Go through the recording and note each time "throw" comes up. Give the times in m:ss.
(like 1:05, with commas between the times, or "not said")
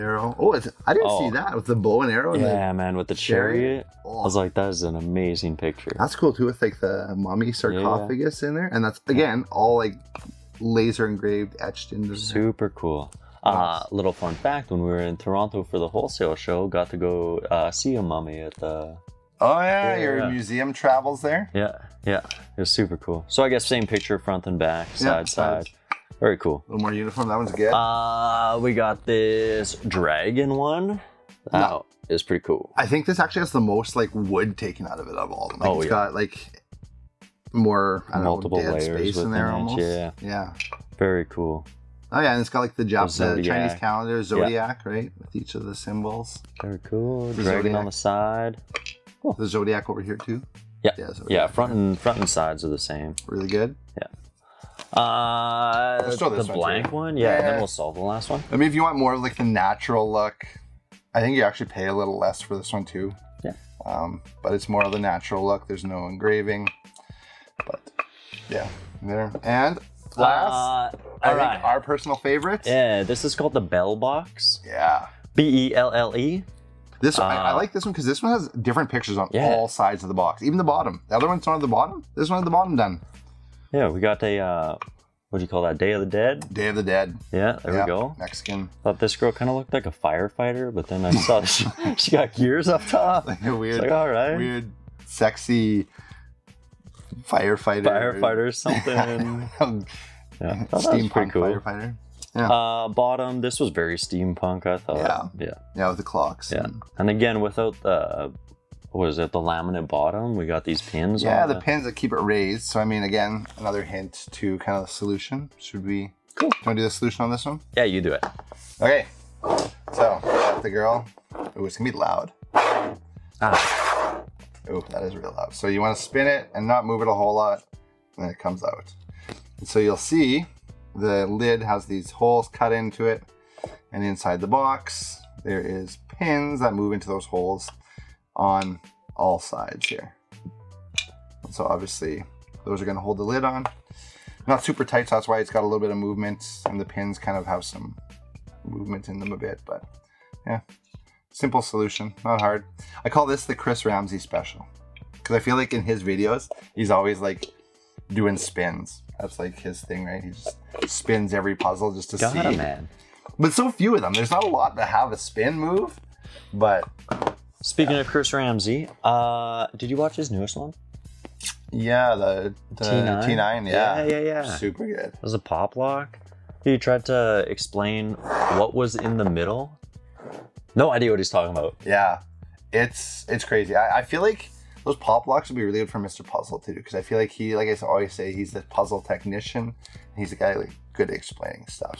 0:56.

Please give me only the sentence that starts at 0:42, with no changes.
Oh yeah, and it's got like the Jap- the Chinese calendar, zodiac, yeah.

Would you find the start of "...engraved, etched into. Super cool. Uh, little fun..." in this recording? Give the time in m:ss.
0:11.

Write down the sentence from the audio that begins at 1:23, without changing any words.
Yeah, we got a uh, what do you call that?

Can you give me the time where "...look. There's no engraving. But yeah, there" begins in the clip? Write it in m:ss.
1:05.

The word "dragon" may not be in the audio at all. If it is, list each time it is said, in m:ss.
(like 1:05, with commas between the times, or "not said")
0:29, 0:47.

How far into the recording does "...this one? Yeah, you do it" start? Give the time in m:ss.
1:57.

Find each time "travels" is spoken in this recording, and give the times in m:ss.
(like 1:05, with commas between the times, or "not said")
0:20.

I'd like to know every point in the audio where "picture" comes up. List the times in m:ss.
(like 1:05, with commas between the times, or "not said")
0:05, 0:23, 1:18.